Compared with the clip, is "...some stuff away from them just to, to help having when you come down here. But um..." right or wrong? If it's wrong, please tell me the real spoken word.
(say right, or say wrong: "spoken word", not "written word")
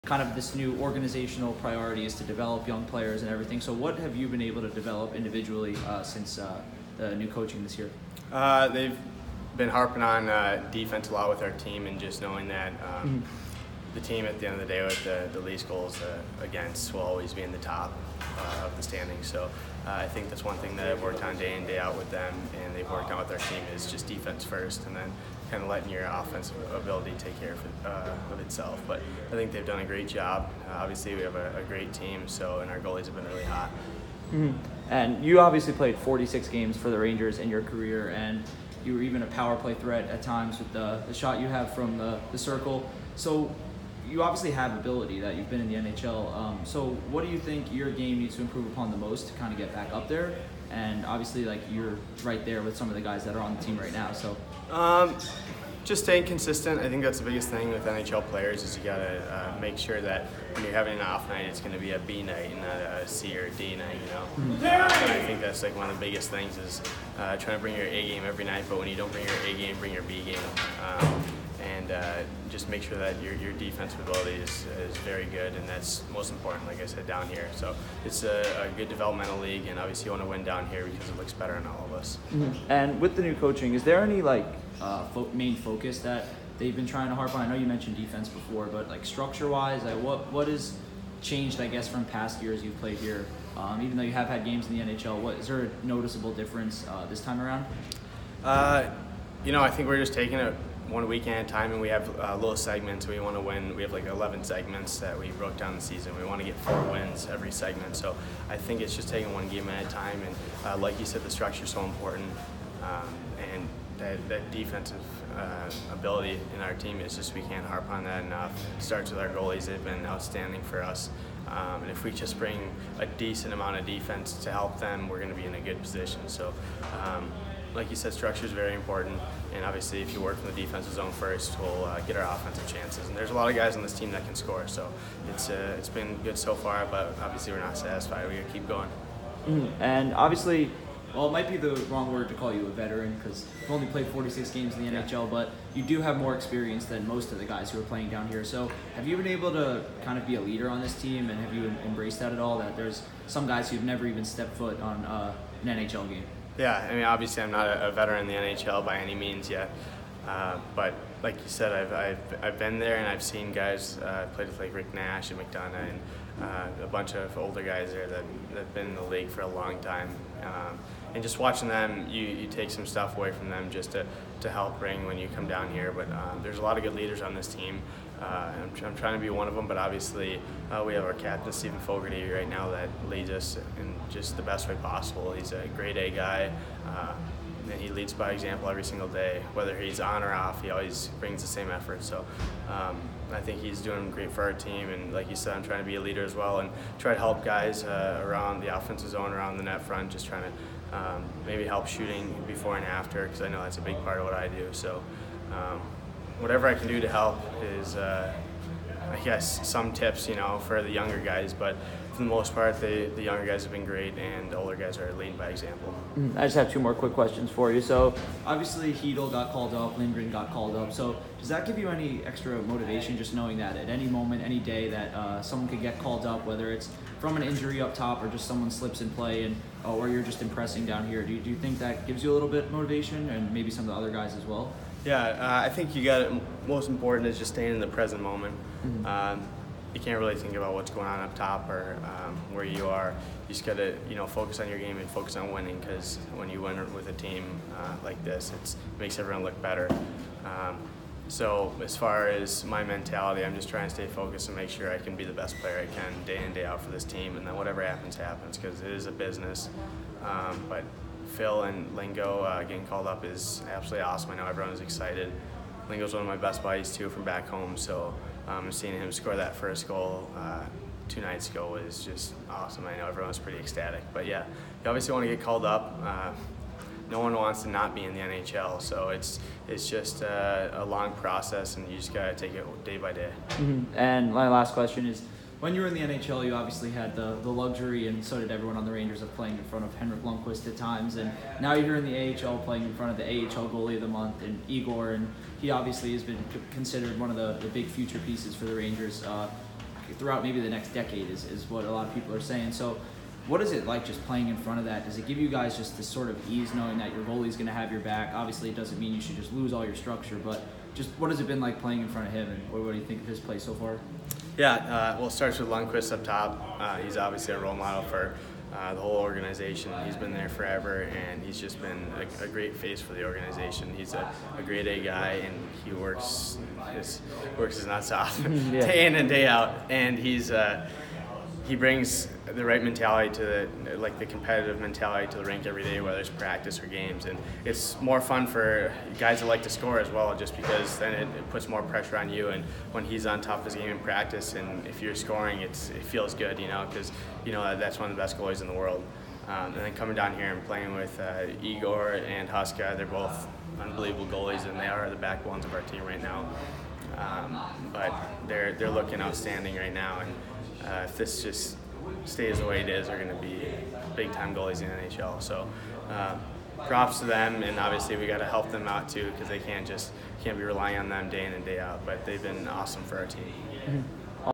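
wrong: "bring", not "having".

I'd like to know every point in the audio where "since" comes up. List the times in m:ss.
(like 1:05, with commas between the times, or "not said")
0:06.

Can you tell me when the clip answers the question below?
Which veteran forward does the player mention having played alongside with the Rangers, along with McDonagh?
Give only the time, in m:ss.
2:44.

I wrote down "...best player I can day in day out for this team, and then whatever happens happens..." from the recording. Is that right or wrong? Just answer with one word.
right.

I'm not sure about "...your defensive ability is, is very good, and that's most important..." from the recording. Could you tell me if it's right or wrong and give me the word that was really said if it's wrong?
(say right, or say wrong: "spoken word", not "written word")
right.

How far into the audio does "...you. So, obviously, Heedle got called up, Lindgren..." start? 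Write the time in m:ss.
3:37.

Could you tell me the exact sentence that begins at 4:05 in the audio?
Because when you win with a team uh, like this, it makes everyone look better.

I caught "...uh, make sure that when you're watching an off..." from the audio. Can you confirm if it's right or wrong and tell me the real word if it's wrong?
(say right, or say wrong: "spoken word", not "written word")
wrong: "having", not "watching".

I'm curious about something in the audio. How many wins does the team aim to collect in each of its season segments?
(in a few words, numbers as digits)
4.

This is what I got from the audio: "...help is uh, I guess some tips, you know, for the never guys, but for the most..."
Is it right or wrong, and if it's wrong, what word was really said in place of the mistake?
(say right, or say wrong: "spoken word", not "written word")
wrong: "younger", not "never".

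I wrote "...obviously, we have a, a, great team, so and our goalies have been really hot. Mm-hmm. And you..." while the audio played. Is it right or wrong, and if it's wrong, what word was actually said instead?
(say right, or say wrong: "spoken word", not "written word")
right.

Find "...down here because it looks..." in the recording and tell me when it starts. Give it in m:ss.
1:20.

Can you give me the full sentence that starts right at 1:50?
And uh, like you said, the structure is so important.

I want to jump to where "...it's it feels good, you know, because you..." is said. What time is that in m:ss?
5:45.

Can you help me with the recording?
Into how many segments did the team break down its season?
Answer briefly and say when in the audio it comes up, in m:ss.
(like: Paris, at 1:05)
11, at 1:44.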